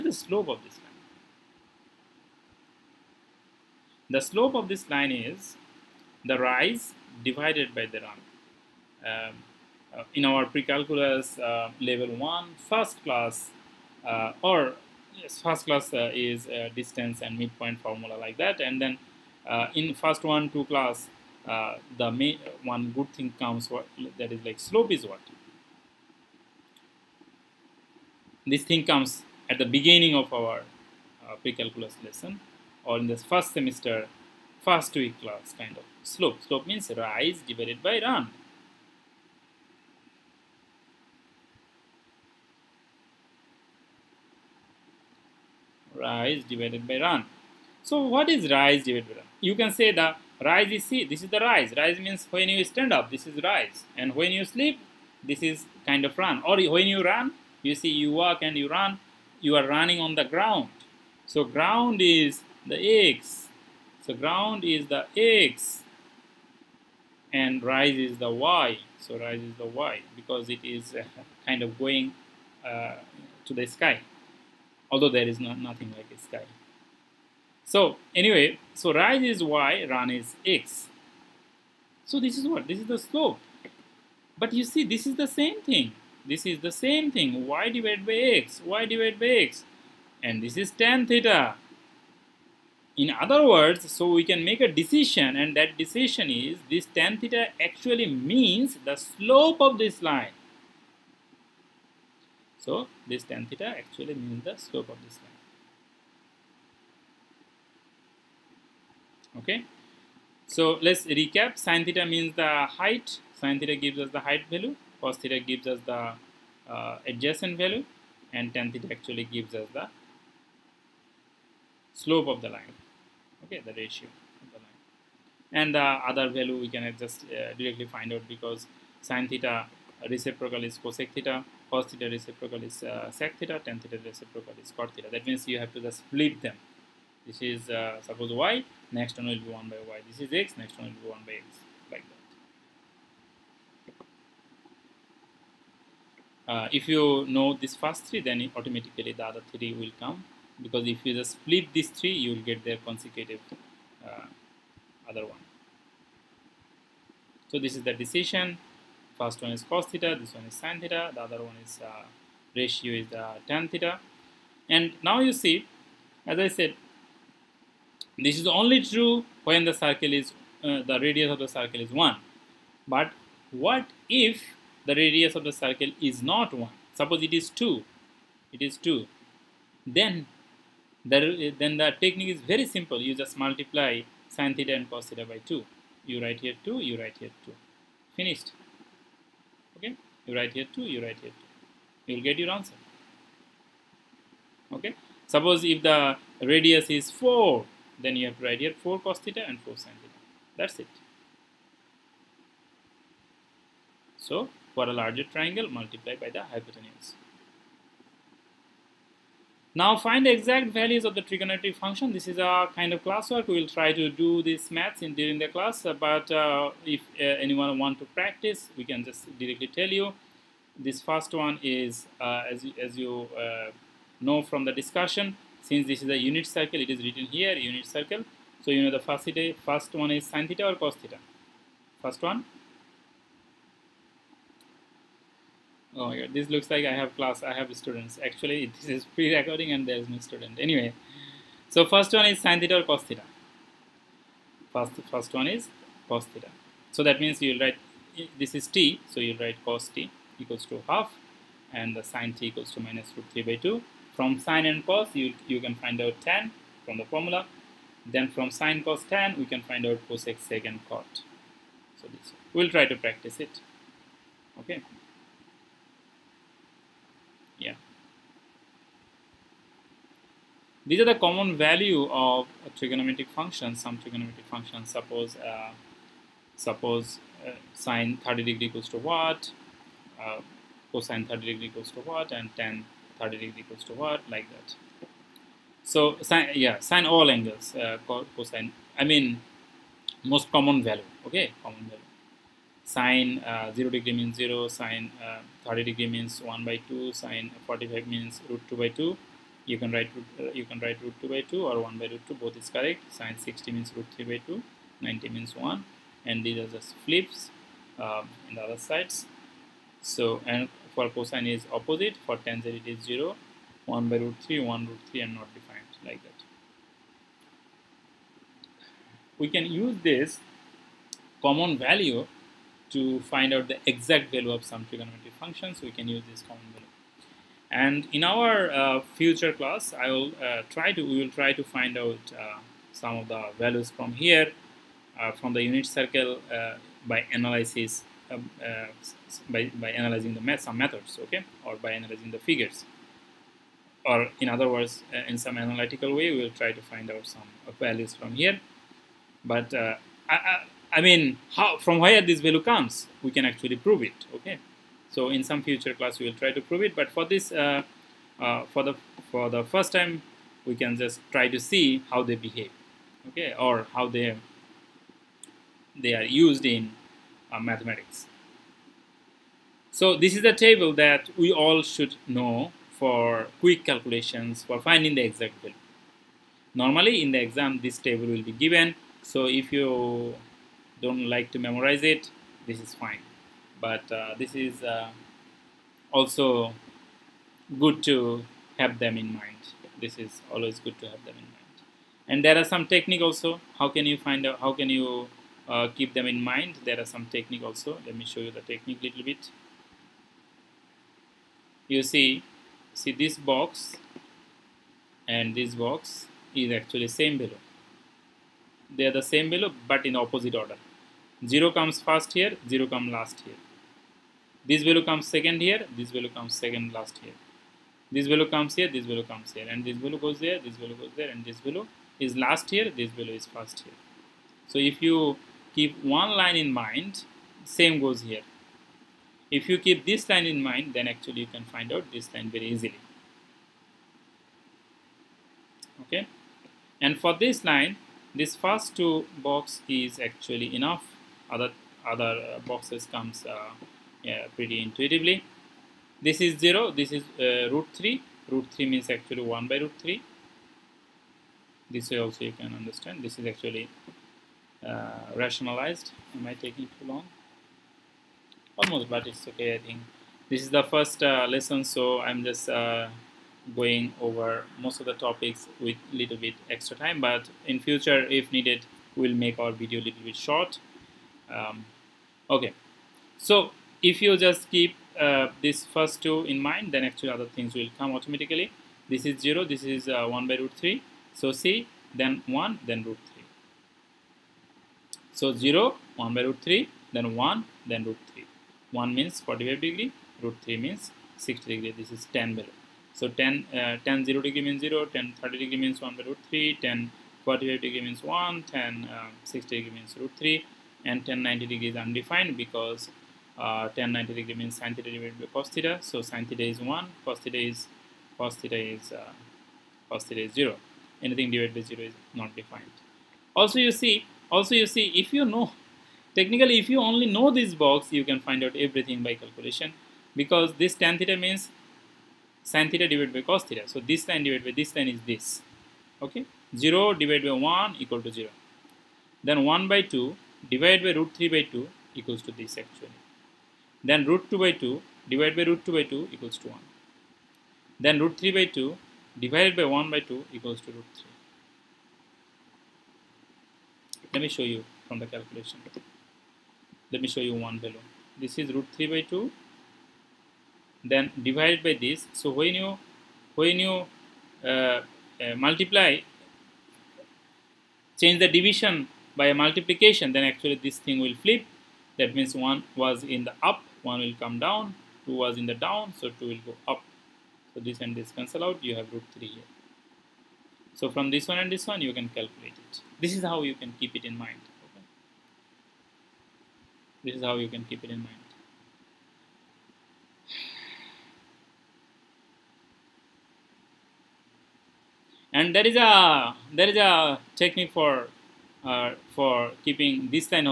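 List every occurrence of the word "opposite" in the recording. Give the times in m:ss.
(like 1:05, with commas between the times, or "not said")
5:11, 6:50.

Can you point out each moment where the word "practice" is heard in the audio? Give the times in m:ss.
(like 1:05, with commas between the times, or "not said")
3:38, 4:22.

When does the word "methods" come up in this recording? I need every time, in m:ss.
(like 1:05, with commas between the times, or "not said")
5:40.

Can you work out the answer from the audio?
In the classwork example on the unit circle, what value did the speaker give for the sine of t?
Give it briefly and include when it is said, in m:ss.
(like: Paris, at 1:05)
minus root 3 by 2, at 4:12.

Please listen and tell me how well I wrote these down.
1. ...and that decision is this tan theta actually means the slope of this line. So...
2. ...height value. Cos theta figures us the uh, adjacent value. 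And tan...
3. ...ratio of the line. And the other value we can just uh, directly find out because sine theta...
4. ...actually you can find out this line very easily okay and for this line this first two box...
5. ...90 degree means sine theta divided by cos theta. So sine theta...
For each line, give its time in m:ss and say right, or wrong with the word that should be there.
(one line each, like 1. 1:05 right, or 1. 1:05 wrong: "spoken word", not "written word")
1. 1:35 right
2. 1:54 wrong: "gives", not "figures"
3. 2:03 right
4. 7:11 right
5. 8:24 right.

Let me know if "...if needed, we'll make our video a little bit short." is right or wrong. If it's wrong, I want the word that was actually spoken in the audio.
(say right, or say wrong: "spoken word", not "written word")
right.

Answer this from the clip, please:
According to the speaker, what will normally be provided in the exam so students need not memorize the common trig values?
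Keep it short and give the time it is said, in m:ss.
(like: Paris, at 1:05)
this table, at 6:17.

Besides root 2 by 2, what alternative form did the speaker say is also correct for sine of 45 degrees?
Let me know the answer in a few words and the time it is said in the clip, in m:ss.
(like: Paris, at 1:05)
1 by root 2, at 5:01.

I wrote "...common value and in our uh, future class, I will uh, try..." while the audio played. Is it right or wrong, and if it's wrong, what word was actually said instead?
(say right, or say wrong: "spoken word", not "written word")
right.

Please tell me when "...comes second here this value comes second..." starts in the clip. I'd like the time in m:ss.
6:55.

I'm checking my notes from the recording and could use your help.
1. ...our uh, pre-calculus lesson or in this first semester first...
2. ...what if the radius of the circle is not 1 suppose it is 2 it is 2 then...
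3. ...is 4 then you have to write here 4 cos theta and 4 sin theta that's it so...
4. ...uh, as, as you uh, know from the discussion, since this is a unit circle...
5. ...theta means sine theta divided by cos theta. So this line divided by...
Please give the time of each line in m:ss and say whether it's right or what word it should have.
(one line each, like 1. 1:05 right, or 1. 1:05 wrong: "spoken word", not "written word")
1. 0:30 right
2. 2:53 right
3. 3:16 right
4. 3:42 right
5. 8:41 right.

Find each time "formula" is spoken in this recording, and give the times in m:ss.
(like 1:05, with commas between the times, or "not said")
0:17, 4:17.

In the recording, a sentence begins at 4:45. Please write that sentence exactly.
So yeah, sine all angles, uh, cosine.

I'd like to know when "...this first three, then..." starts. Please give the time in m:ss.
2:27.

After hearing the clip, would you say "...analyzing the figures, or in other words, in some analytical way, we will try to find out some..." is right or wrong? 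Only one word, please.
right.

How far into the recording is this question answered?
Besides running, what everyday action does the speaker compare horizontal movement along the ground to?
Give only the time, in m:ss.
0:54.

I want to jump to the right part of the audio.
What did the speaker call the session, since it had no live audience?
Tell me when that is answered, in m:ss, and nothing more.
3:59.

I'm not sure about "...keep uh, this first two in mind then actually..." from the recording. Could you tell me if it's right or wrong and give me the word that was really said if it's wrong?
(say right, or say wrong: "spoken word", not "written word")
right.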